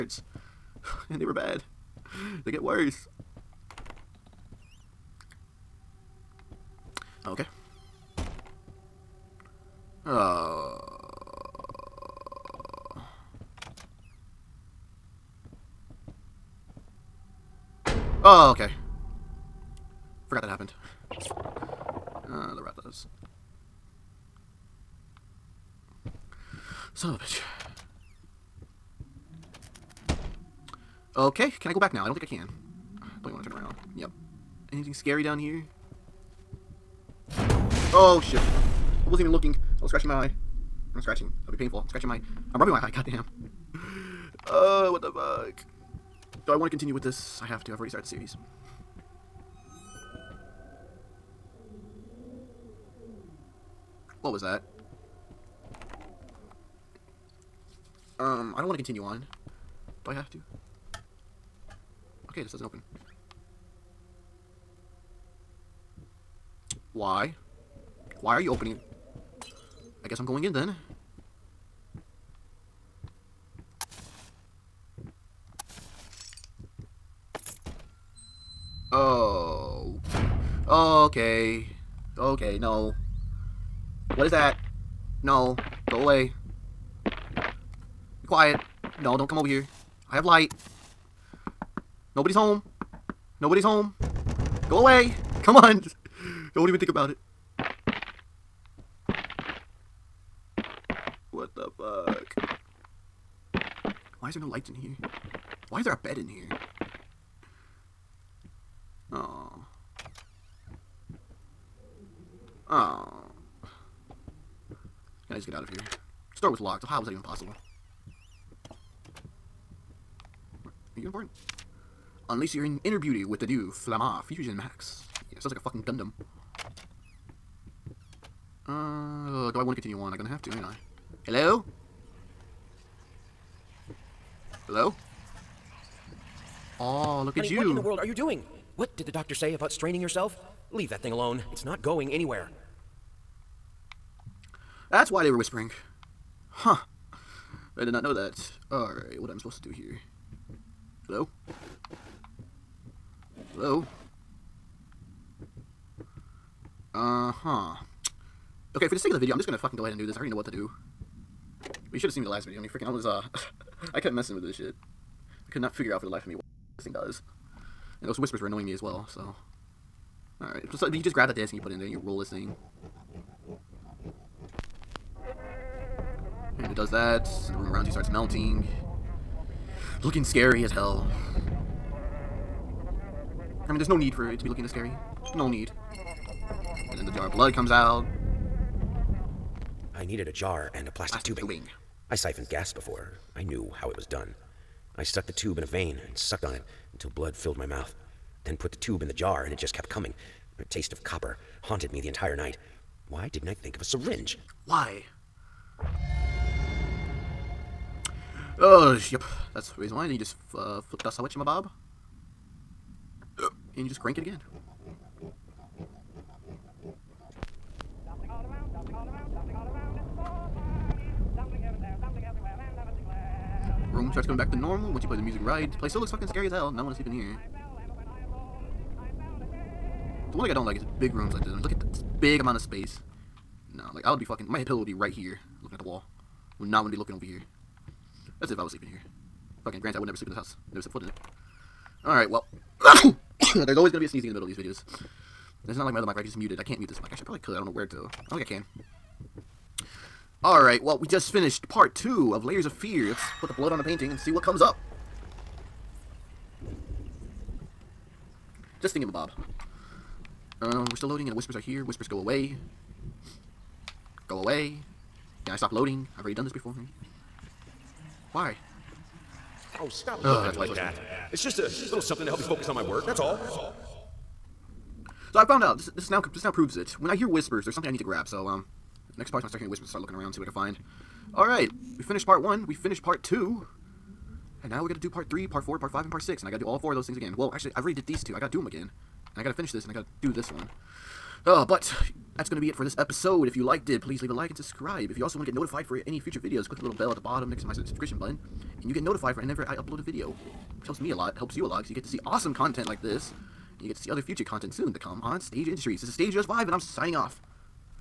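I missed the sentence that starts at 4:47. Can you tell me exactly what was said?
Well, actually, I already did these two.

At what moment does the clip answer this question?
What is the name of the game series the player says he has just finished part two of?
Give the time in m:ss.
4:12.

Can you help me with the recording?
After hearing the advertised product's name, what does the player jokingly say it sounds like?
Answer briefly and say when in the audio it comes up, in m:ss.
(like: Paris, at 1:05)
Gundam, at 2:05.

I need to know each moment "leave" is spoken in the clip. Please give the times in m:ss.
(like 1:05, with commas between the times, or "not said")
2:20, 4:54.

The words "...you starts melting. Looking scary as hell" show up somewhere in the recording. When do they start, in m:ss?
2:57.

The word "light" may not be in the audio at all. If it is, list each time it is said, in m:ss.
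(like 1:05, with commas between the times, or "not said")
1:30, 1:44.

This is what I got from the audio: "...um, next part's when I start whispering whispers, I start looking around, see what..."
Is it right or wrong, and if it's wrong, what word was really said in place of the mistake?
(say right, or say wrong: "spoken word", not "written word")
wrong: "hearing", not "whispering".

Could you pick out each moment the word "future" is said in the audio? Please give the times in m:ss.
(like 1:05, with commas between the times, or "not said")
4:56, 5:04.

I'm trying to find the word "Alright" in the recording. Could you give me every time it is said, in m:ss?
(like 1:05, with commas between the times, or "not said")
2:28, 2:50, 4:02, 4:10.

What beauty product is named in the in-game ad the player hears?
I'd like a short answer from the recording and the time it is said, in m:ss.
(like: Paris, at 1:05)
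Flamma Fusion Max, at 2:03.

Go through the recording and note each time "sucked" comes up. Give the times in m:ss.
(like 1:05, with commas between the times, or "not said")
3:16.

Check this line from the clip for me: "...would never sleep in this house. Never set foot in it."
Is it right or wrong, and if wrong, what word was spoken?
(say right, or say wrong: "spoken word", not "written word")
right.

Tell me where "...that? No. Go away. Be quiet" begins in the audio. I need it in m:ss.
1:24.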